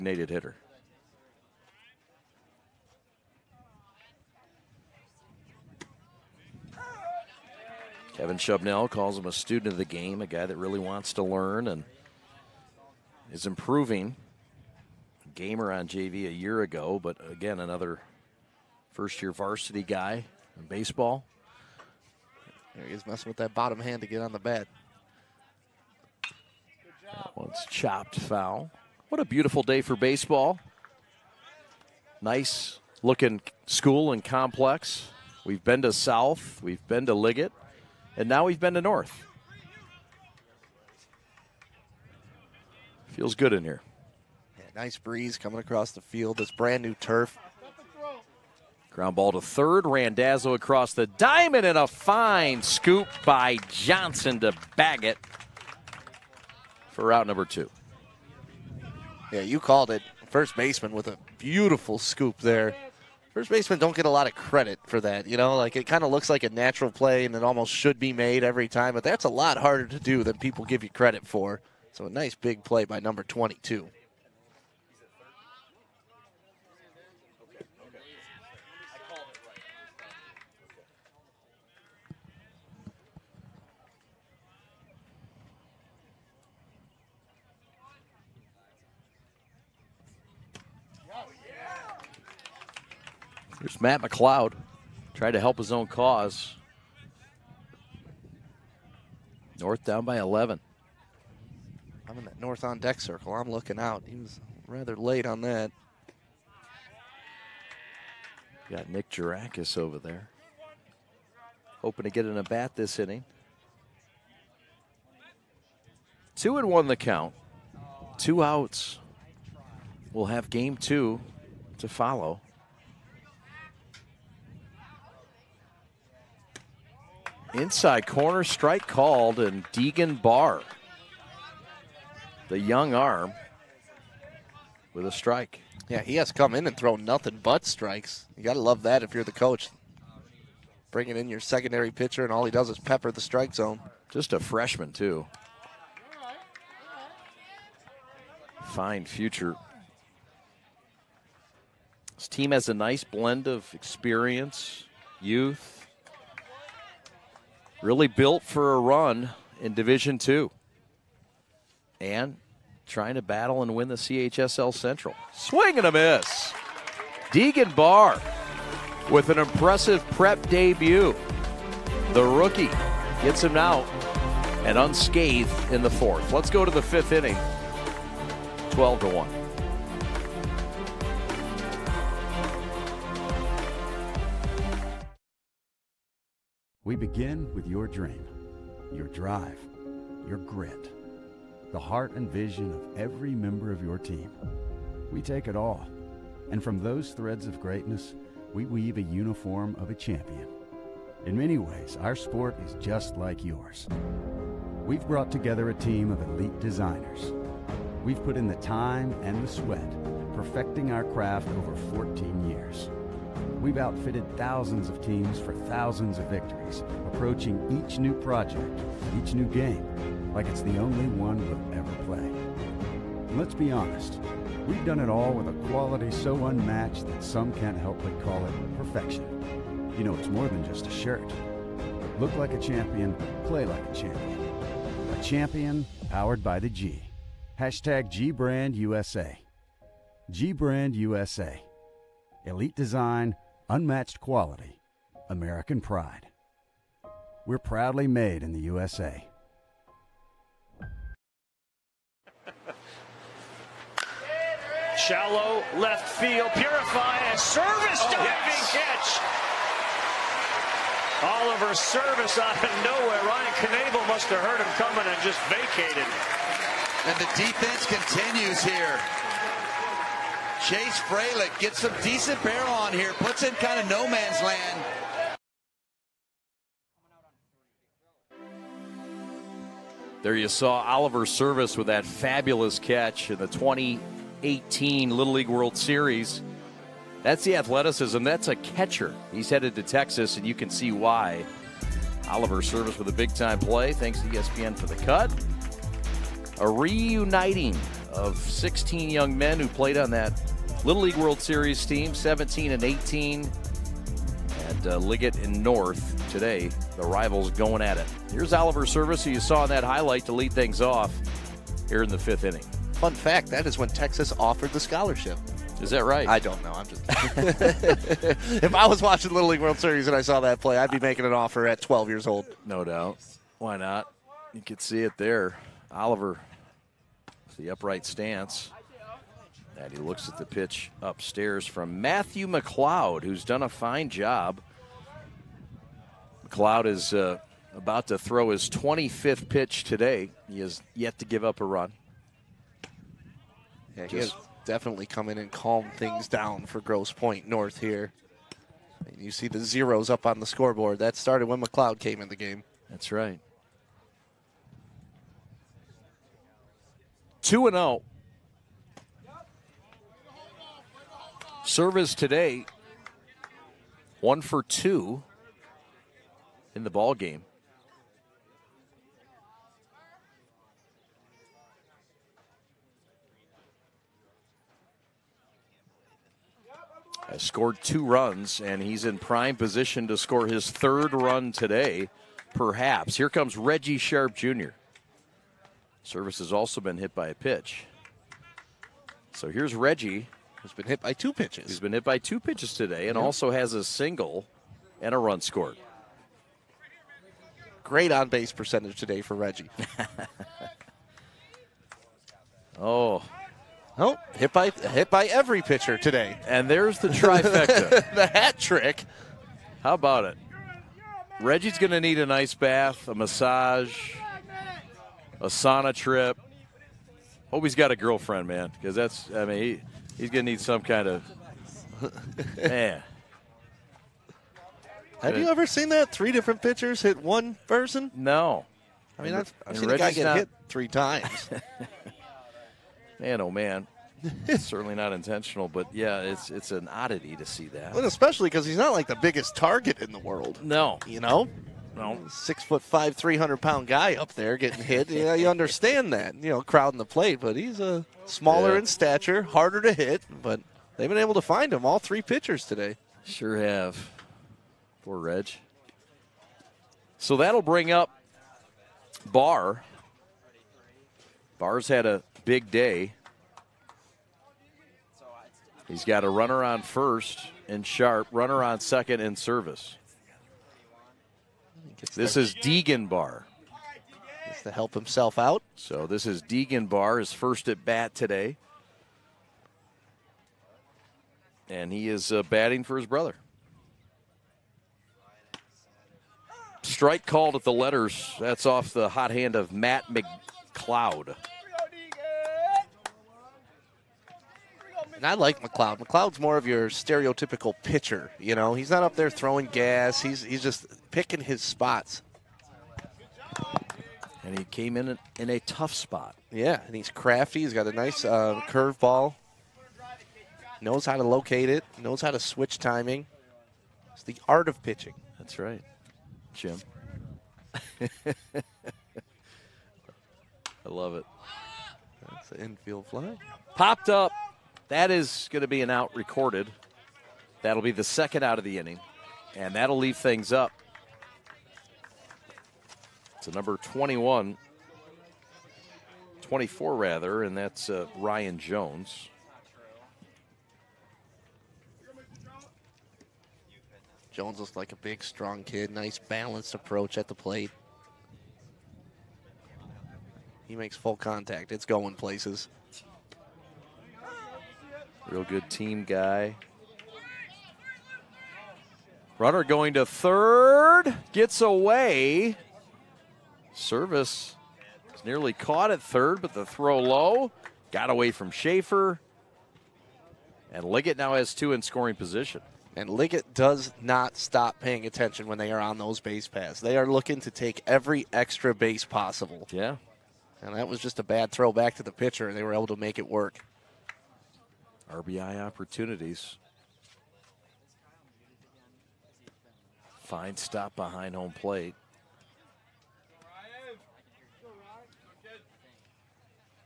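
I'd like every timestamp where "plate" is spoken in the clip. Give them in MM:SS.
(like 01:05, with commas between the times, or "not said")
07:27, 09:07, 09:51.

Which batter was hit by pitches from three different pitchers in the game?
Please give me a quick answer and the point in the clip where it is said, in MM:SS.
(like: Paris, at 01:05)
Reggie Sharp Jr., at 06:23.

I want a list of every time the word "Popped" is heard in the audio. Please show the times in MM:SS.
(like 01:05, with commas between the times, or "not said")
08:43.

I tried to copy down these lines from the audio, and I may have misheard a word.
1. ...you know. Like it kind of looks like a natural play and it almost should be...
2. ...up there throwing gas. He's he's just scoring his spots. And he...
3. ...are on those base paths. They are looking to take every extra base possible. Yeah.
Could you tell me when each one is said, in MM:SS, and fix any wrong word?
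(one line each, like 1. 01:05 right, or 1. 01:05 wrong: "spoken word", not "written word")
1. 01:05 right
2. 08:19 wrong: "picking", not "scoring"
3. 09:35 right.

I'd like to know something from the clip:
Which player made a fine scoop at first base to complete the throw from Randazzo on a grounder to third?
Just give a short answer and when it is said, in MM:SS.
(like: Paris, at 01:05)
Johnson, at 00:53.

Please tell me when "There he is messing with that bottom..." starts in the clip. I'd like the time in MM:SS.
00:22.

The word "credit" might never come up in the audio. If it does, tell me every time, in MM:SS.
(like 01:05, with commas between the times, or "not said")
01:04, 01:10.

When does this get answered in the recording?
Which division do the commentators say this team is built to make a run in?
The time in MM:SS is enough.
02:39.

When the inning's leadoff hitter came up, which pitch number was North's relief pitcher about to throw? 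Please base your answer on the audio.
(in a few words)
25th.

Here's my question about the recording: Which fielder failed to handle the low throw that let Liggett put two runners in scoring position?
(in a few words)
Schaefer.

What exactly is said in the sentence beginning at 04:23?
Ryan Knable must have heard him coming and just vacated.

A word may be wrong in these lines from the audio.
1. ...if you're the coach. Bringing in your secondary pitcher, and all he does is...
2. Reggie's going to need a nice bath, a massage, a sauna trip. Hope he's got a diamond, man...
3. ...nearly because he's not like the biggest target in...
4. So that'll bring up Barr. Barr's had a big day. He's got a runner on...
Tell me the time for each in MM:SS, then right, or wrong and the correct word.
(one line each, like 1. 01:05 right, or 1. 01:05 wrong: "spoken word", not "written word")
1. 02:19 right
2. 06:51 wrong: "girlfriend", not "diamond"
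3. 07:18 wrong: "especially", not "nearly"
4. 07:37 right.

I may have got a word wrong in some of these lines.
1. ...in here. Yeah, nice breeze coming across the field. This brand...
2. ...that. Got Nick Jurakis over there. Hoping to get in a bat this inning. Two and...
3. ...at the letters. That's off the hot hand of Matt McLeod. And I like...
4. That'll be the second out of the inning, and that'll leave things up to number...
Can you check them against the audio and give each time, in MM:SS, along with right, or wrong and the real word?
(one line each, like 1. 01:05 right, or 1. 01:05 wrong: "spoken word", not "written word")
1. 00:43 right
2. 01:45 right
3. 08:07 right
4. 08:47 right.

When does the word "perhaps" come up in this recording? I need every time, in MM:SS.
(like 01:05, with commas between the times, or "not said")
06:22.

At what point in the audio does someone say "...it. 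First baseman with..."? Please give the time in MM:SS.
00:59.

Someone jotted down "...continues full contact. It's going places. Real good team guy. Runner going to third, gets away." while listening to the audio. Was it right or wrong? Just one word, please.
wrong.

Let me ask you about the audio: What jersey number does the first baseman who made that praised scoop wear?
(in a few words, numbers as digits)
22.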